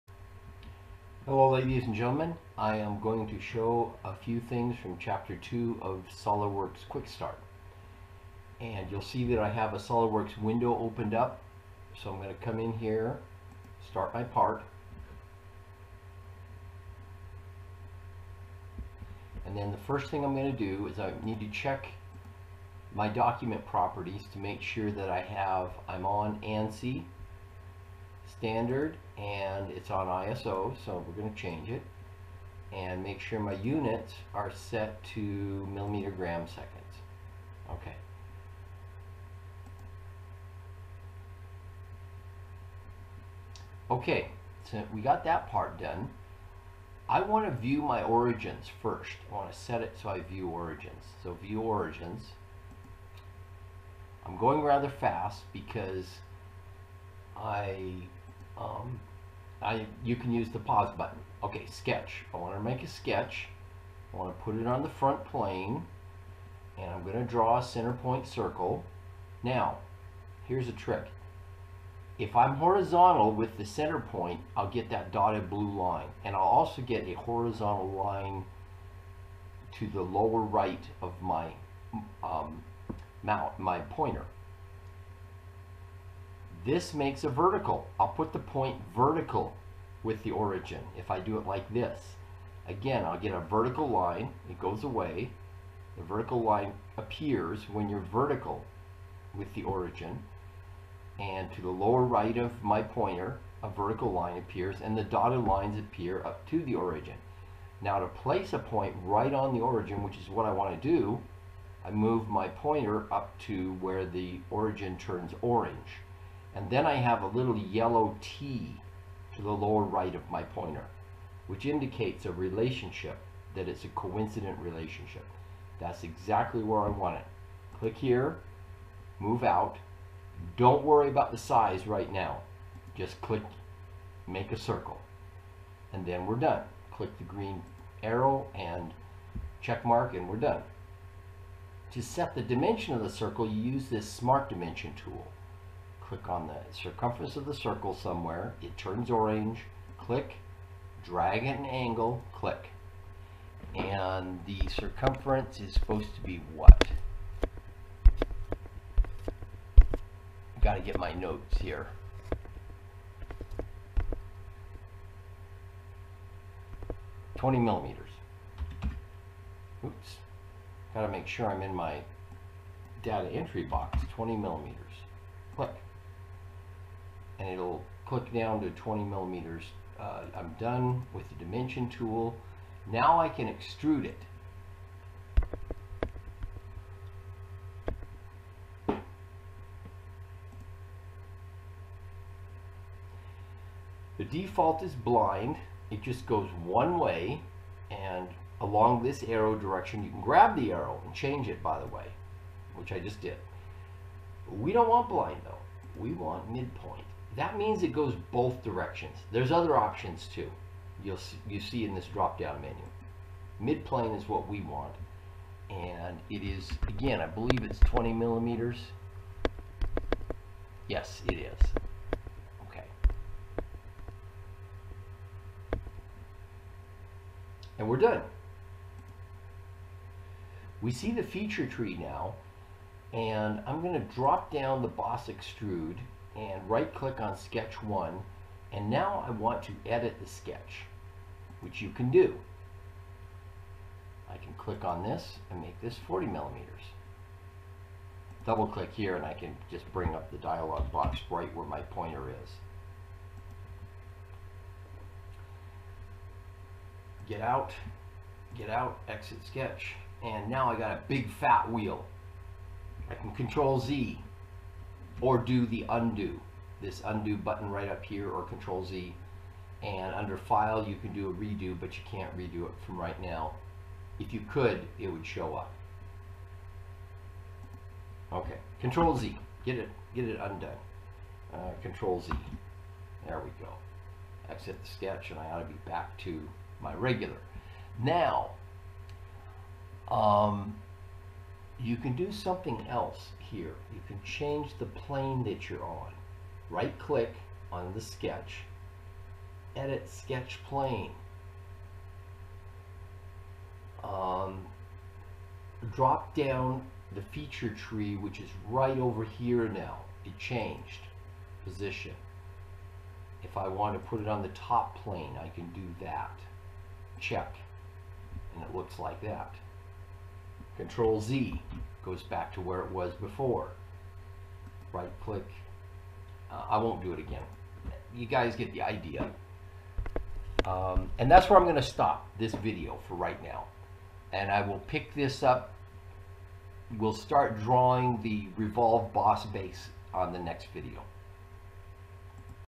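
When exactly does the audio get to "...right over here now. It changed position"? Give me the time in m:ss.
5:08.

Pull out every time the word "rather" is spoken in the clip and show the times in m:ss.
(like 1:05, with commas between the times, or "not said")
0:54.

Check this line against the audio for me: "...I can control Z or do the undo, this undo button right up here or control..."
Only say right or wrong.
right.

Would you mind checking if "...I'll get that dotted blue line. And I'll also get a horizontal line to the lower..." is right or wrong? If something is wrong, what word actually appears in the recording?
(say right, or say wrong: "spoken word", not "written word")
right.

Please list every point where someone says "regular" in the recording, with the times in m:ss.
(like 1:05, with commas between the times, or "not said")
4:46.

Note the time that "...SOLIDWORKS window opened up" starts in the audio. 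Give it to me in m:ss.
0:09.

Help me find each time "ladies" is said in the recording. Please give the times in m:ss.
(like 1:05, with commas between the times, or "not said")
0:01.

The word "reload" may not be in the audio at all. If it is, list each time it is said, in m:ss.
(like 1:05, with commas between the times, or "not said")
not said.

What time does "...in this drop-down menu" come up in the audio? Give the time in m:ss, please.
3:31.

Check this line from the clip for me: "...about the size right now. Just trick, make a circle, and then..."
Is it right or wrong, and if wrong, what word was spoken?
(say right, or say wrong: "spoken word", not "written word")
wrong: "click", not "trick".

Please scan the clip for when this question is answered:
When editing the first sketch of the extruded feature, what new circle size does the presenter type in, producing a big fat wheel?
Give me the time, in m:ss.
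4:06.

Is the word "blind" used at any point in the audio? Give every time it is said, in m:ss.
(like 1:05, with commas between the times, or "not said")
3:14, 3:25.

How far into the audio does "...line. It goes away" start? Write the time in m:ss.
1:33.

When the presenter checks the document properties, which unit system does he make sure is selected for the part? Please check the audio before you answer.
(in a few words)
millimeter gram seconds.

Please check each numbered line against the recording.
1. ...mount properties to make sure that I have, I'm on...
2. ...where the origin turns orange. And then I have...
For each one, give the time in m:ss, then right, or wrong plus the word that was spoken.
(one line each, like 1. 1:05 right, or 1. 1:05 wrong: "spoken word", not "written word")
1. 0:23 wrong: "document", not "mount"
2. 1:53 right.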